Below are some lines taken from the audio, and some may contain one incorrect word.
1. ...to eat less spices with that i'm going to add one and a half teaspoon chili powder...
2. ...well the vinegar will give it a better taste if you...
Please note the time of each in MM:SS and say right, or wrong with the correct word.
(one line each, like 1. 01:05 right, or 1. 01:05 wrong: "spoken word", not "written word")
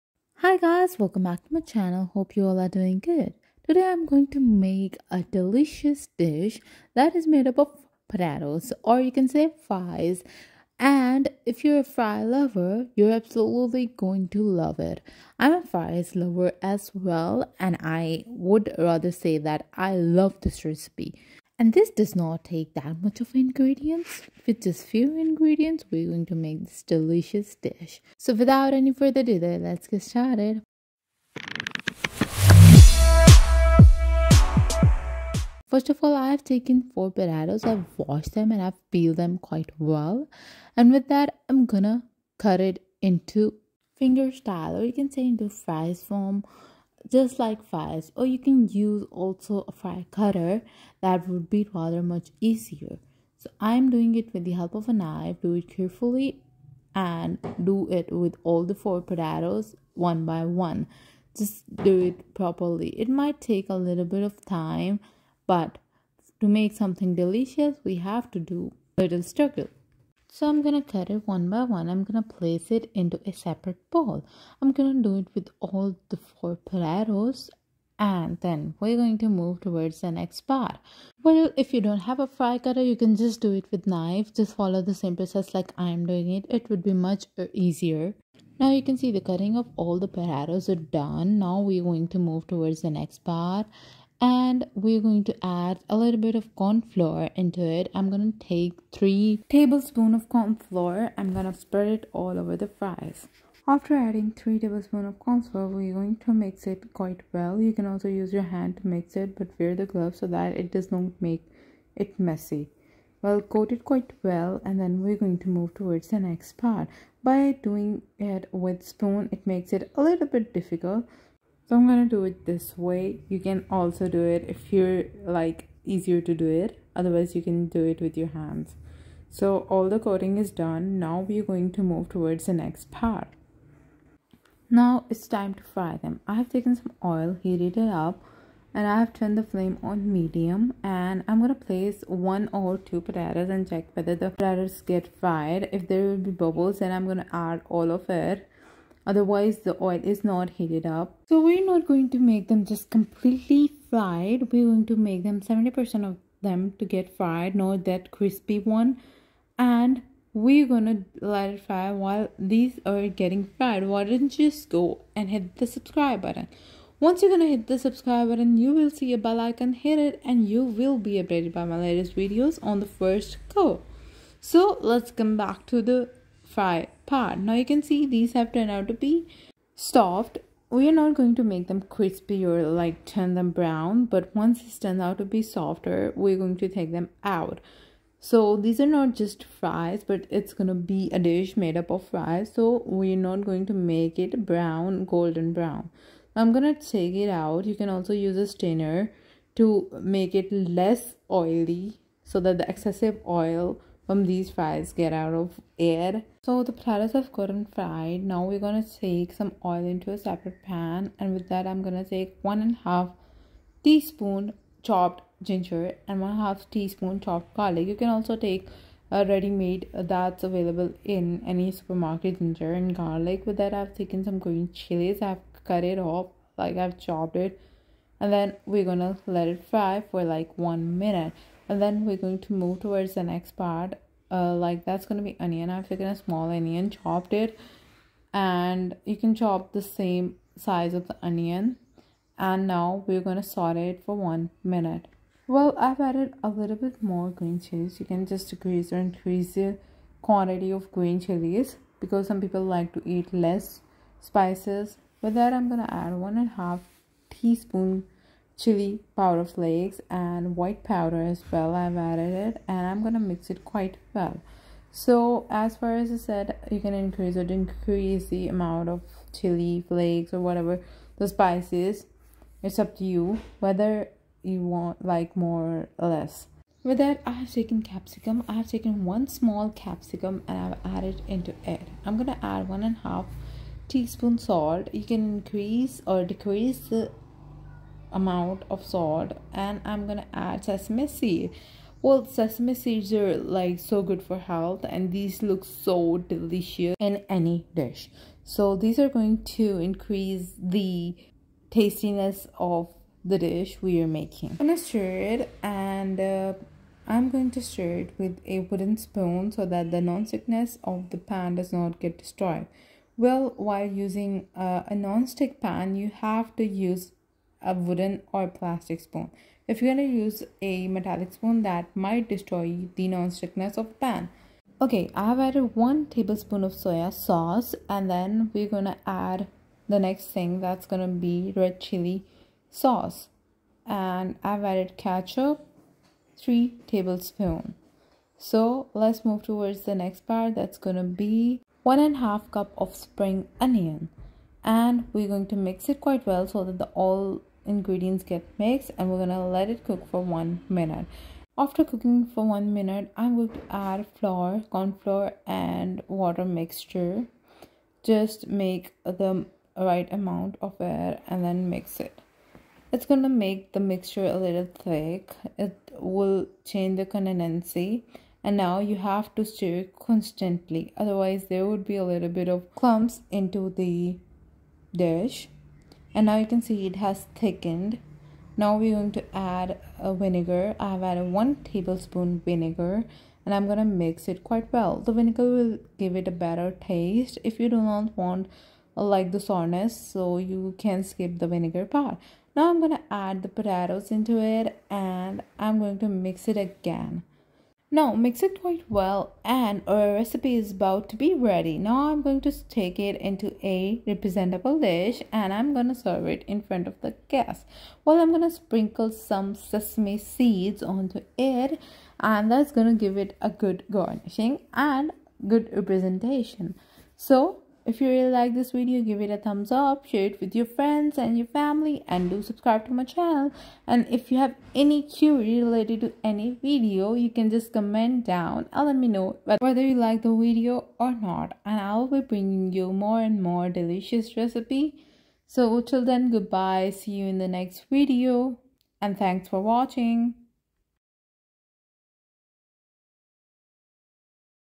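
1. 04:12 right
2. 06:24 right.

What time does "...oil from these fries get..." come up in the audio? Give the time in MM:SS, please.
03:23.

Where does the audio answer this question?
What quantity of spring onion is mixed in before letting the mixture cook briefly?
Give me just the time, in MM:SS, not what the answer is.
05:41.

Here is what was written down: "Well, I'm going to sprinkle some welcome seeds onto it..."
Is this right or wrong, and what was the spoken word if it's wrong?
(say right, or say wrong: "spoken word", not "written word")
wrong: "sesame", not "welcome".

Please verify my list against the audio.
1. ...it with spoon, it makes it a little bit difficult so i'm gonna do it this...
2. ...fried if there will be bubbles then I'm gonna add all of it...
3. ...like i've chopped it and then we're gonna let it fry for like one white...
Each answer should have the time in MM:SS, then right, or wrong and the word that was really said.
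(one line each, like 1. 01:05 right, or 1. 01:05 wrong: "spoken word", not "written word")
1. 01:58 right
2. 02:25 right
3. 03:46 wrong: "minute", not "white".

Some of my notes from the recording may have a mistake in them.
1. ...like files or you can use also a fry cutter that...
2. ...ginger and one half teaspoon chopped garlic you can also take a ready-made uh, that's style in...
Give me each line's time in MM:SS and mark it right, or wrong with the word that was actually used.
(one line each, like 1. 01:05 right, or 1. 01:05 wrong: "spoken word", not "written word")
1. 00:47 right
2. 03:35 wrong: "available", not "style".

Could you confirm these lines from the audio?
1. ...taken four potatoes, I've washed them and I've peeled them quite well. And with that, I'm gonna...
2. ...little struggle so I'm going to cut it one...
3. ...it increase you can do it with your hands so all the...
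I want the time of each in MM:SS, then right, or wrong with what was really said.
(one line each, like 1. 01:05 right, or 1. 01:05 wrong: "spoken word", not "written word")
1. 00:36 right
2. 01:09 right
3. 02:06 wrong: "otherwise", not "increase".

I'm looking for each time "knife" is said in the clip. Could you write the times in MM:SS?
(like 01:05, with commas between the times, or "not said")
00:54, 01:23.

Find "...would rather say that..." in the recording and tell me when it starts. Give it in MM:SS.
00:18.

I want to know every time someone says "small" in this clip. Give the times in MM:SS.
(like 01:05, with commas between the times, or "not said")
03:56, 04:39.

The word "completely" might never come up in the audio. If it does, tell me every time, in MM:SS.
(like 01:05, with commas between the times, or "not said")
02:32.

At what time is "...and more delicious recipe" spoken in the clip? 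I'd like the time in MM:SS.
07:13.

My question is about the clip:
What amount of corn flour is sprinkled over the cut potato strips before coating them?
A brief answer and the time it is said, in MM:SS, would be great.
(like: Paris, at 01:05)
3 tablespoons, at 01:38.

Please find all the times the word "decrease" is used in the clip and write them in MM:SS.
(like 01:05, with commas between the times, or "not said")
04:08, 04:27, 04:46.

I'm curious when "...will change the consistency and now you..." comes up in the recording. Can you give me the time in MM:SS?
06:05.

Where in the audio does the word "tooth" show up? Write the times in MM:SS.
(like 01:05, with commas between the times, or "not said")
not said.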